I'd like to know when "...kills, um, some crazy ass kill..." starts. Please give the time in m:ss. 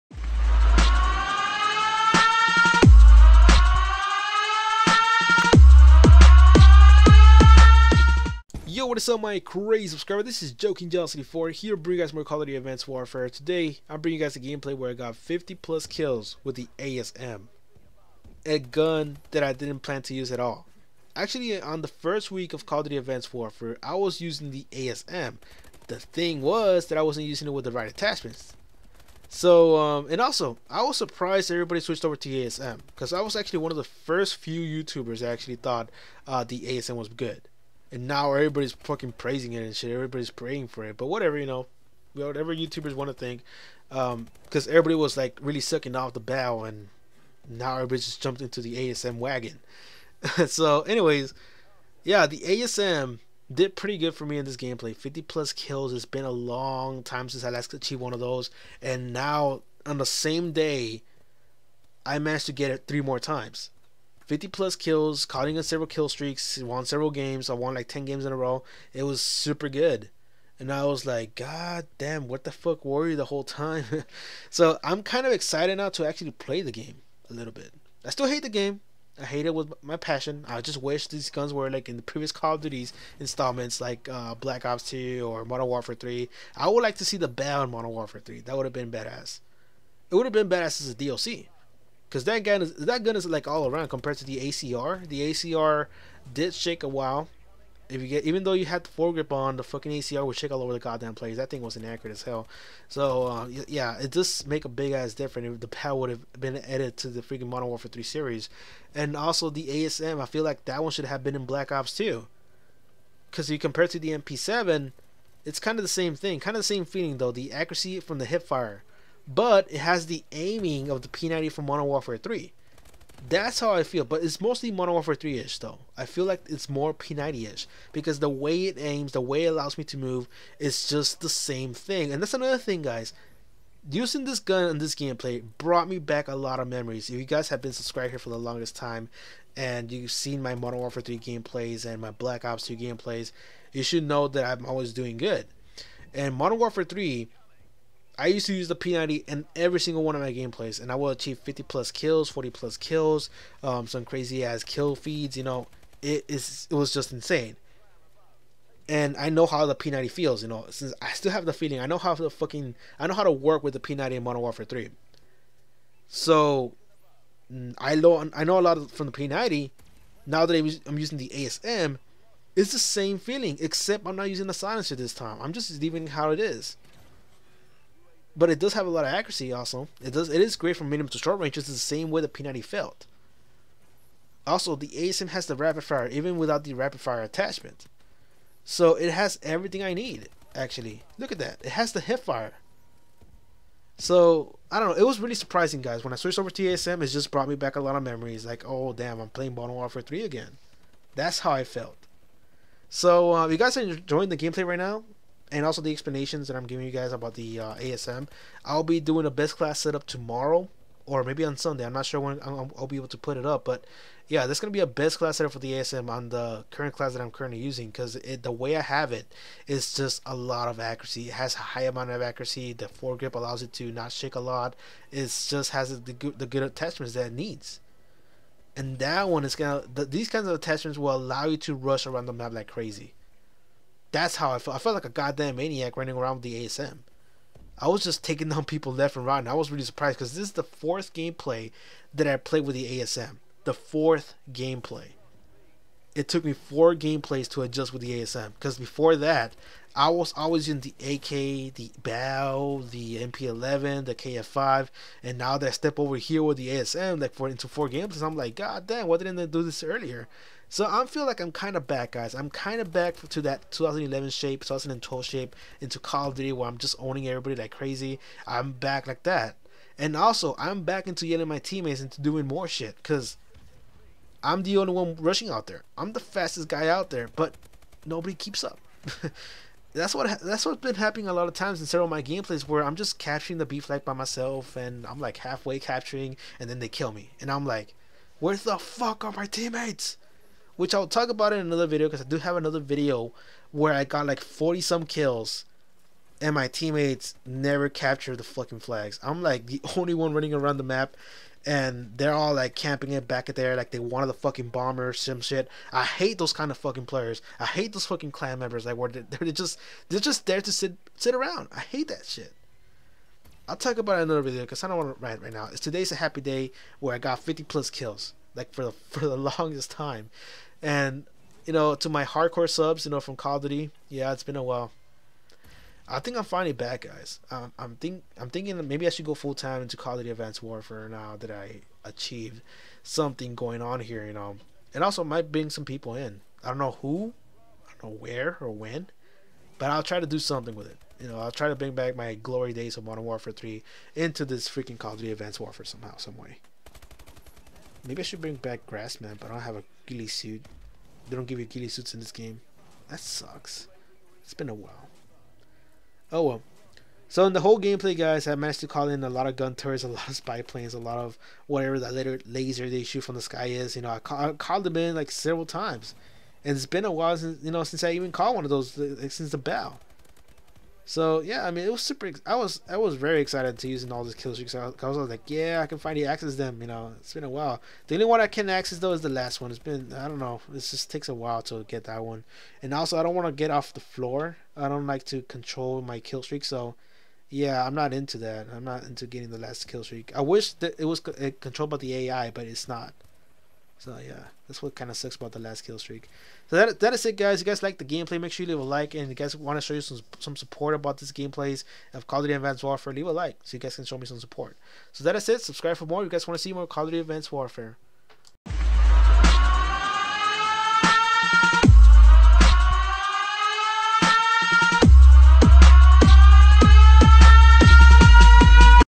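2:32.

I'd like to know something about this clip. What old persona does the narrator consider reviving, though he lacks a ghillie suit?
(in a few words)
Grassman.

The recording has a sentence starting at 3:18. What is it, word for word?
Like, oh damn, I'm playing Modern Warfare 3 again.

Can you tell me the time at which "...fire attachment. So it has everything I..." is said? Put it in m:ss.
3:07.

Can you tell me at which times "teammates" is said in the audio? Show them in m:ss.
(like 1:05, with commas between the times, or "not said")
4:31, 4:49, 4:56.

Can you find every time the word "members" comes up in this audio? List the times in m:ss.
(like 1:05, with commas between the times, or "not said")
5:08.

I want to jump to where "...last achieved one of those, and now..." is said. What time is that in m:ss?
0:57.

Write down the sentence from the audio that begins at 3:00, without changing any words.
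It is great from medium to short range.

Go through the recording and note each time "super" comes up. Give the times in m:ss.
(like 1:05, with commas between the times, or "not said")
1:09, 6:12.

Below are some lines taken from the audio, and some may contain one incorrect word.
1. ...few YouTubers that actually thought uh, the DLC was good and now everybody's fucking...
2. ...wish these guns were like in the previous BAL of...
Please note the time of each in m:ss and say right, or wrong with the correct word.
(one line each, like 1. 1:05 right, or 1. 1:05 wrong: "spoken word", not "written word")
1. 0:34 wrong: "ASM", not "DLC"
2. 1:20 wrong: "Call", not "BAL".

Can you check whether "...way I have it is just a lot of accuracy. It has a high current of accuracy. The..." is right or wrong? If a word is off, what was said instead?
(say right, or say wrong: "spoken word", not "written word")
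wrong: "amount", not "current".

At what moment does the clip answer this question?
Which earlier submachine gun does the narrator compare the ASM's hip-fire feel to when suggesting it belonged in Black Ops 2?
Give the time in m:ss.
1:54.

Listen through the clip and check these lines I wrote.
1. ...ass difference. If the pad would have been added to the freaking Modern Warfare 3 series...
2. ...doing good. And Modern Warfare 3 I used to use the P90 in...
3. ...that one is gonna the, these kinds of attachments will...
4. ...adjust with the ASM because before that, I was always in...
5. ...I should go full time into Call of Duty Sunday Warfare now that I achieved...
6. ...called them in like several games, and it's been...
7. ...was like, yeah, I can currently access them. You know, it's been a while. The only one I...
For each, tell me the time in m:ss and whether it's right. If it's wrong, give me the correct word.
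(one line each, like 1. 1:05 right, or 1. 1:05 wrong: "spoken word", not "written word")
1. 1:44 right
2. 2:24 right
3. 3:48 right
4. 4:07 right
5. 5:29 wrong: "Advanced", not "Sunday"
6. 6:04 wrong: "times", not "games"
7. 6:15 wrong: "finally", not "currently".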